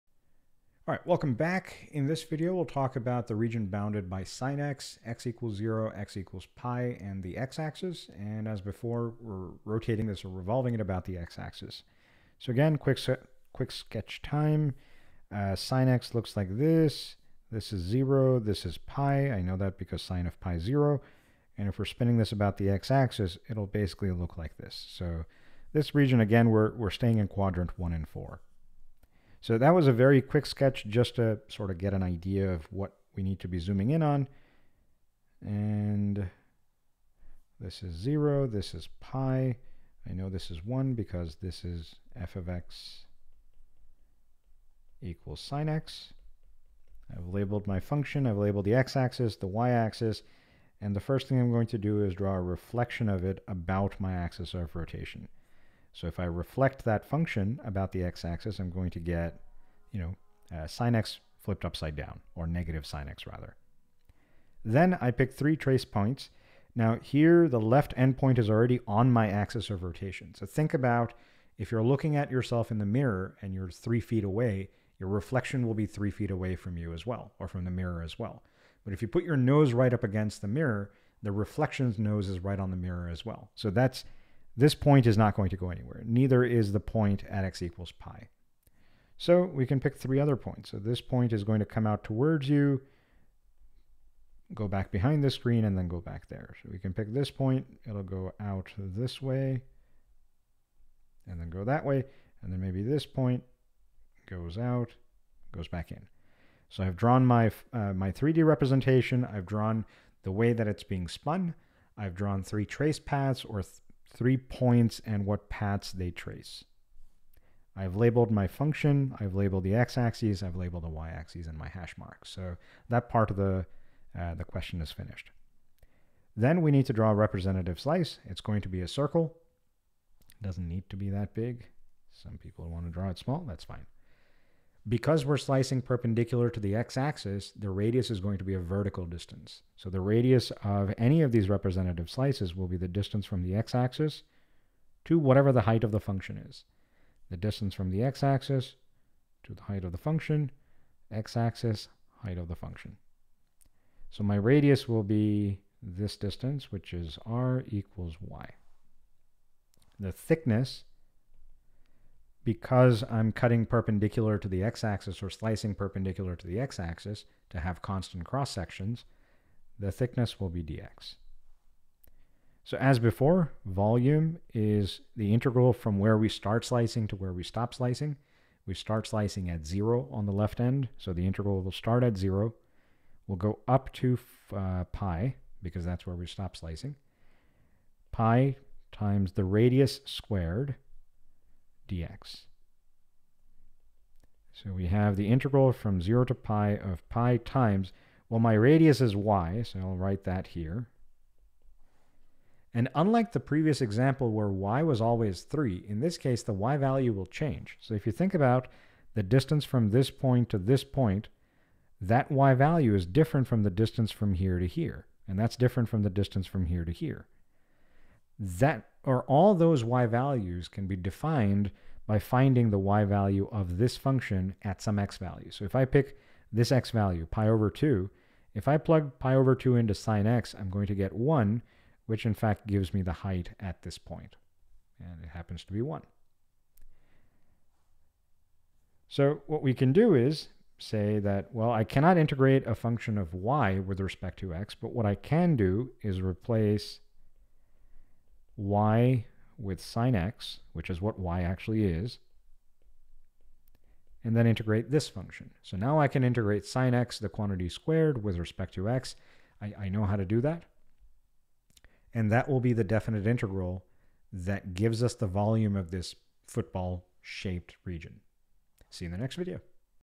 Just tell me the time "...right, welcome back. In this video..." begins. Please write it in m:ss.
0:00.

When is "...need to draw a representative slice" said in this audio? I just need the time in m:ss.
2:06.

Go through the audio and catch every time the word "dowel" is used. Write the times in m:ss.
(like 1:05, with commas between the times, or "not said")
not said.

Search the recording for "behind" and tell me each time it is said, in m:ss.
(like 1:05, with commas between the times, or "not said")
1:34.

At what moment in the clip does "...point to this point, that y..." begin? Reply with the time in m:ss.
3:30.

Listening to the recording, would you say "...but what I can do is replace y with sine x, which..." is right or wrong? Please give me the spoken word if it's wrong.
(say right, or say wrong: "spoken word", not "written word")
right.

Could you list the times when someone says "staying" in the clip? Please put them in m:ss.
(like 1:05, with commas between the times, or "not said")
0:26.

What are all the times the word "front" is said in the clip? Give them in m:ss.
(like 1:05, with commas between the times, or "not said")
not said.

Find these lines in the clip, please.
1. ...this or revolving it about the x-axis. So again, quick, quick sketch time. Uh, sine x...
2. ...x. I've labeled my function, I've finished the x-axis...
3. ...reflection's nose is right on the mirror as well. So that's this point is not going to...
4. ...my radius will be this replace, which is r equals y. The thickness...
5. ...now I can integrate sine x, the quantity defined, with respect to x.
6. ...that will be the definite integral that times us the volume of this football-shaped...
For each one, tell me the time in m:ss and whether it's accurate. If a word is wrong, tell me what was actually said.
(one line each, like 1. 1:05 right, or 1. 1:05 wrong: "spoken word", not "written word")
1. 0:10 right
2. 0:45 wrong: "labeled", not "finished"
3. 1:21 right
4. 2:34 wrong: "distance", not "replace"
5. 4:15 wrong: "squared", not "defined"
6. 4:22 wrong: "gives", not "times".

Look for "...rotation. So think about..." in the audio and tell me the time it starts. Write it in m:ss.
1:09.